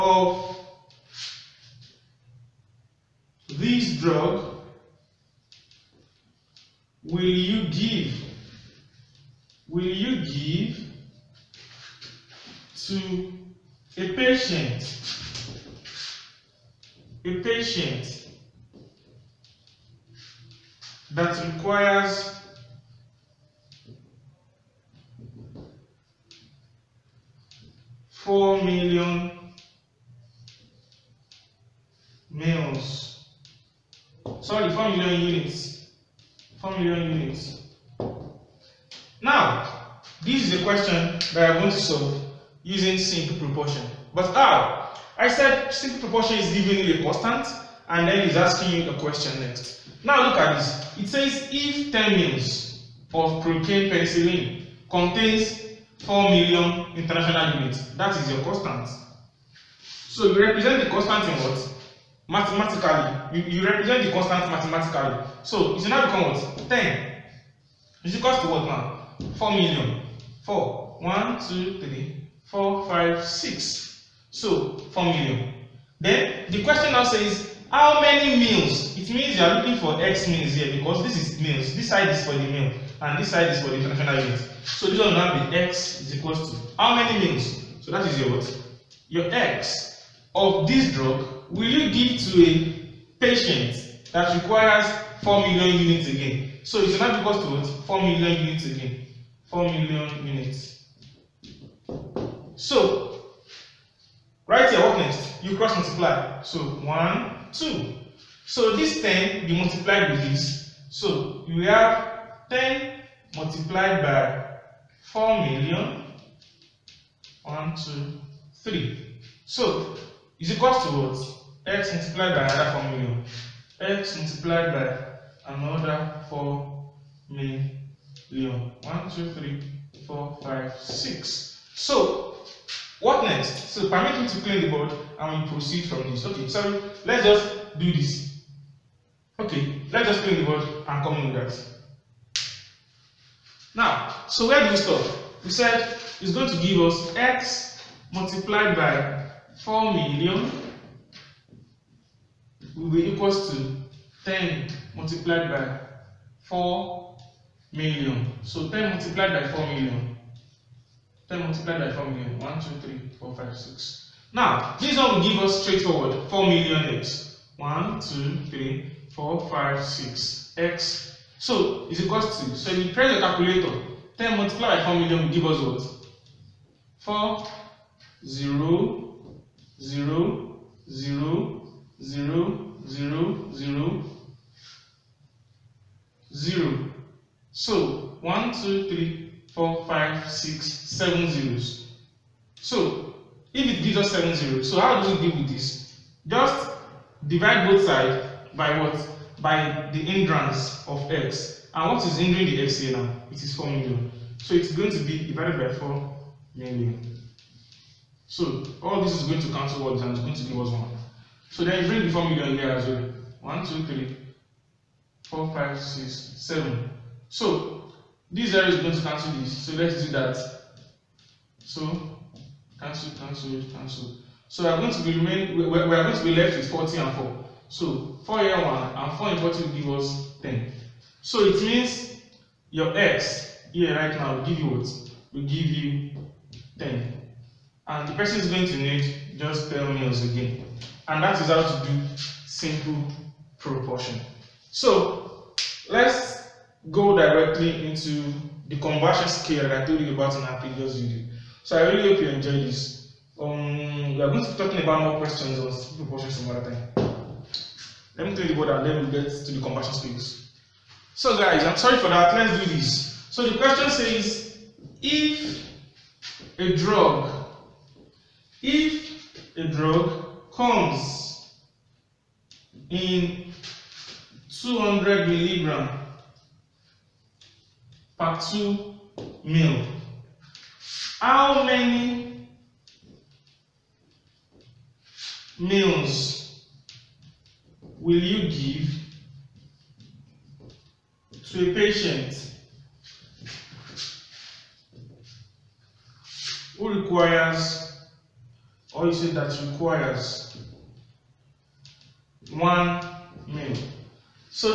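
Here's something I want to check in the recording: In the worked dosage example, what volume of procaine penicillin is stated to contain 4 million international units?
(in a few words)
10 mils.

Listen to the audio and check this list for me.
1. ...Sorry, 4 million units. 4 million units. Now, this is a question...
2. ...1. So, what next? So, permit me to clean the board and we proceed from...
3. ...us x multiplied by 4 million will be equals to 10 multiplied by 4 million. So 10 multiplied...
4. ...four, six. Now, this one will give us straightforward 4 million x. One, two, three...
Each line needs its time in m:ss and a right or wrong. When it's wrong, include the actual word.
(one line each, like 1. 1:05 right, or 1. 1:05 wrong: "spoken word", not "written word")
1. 0:34 right
2. 2:10 wrong: "6", not "1"
3. 2:26 right
4. 2:43 wrong: "five", not "four".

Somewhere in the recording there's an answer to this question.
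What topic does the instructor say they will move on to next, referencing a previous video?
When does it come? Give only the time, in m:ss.
4:08.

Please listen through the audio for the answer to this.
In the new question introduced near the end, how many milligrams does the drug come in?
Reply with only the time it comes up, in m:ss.
4:34.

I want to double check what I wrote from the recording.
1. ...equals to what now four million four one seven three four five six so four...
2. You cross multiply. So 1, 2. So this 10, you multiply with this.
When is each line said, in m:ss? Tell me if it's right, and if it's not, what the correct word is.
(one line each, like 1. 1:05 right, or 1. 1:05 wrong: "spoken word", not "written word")
1. 1:08 wrong: "two", not "seven"
2. 1:45 right.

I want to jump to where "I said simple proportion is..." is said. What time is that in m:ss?
0:45.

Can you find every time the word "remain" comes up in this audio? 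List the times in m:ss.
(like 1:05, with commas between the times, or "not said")
3:45.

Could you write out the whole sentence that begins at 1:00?
So you represent the constant in what?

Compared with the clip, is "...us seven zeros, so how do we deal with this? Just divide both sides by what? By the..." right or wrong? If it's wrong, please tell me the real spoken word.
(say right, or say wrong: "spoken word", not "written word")
right.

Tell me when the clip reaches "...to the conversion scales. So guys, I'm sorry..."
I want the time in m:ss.
4:19.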